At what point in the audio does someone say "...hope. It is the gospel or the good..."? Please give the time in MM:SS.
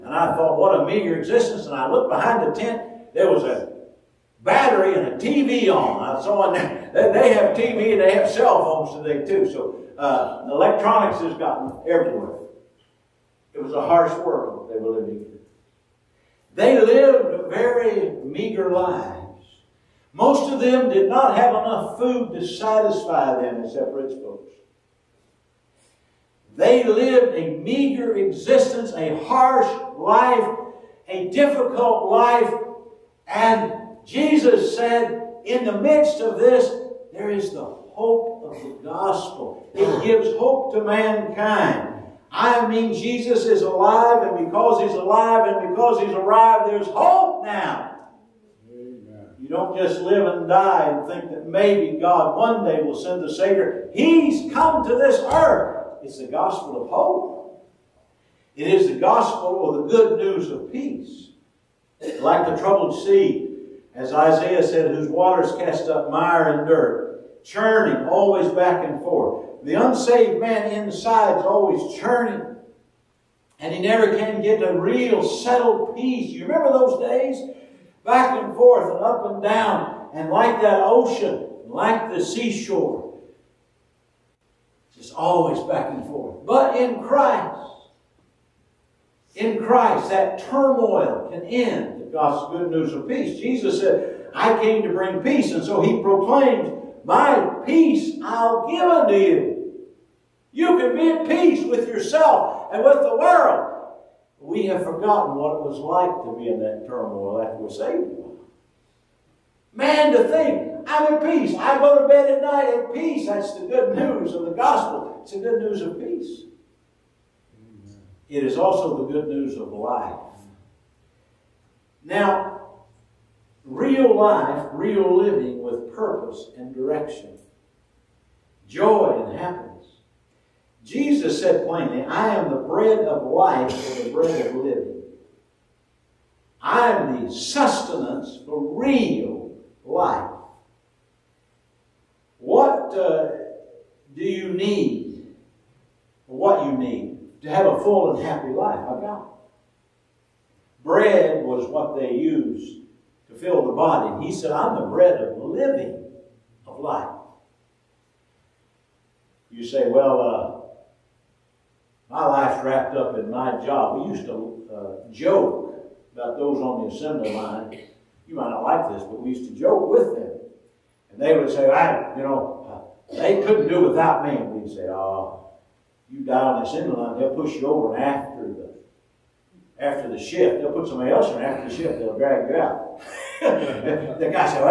00:56.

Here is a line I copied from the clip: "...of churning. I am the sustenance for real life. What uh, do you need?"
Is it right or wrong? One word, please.
wrong.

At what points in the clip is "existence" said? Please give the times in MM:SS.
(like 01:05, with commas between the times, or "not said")
00:01, 00:28.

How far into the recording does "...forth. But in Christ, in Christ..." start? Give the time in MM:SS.
01:26.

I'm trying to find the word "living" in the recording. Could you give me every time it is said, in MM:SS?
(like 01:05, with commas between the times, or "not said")
00:15, 02:05, 02:14, 02:35.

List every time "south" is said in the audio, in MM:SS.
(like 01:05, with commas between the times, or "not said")
not said.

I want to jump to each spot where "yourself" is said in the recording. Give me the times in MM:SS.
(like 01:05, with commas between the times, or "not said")
01:41.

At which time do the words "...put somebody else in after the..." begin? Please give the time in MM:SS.
03:00.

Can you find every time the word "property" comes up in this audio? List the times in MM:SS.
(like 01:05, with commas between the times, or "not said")
not said.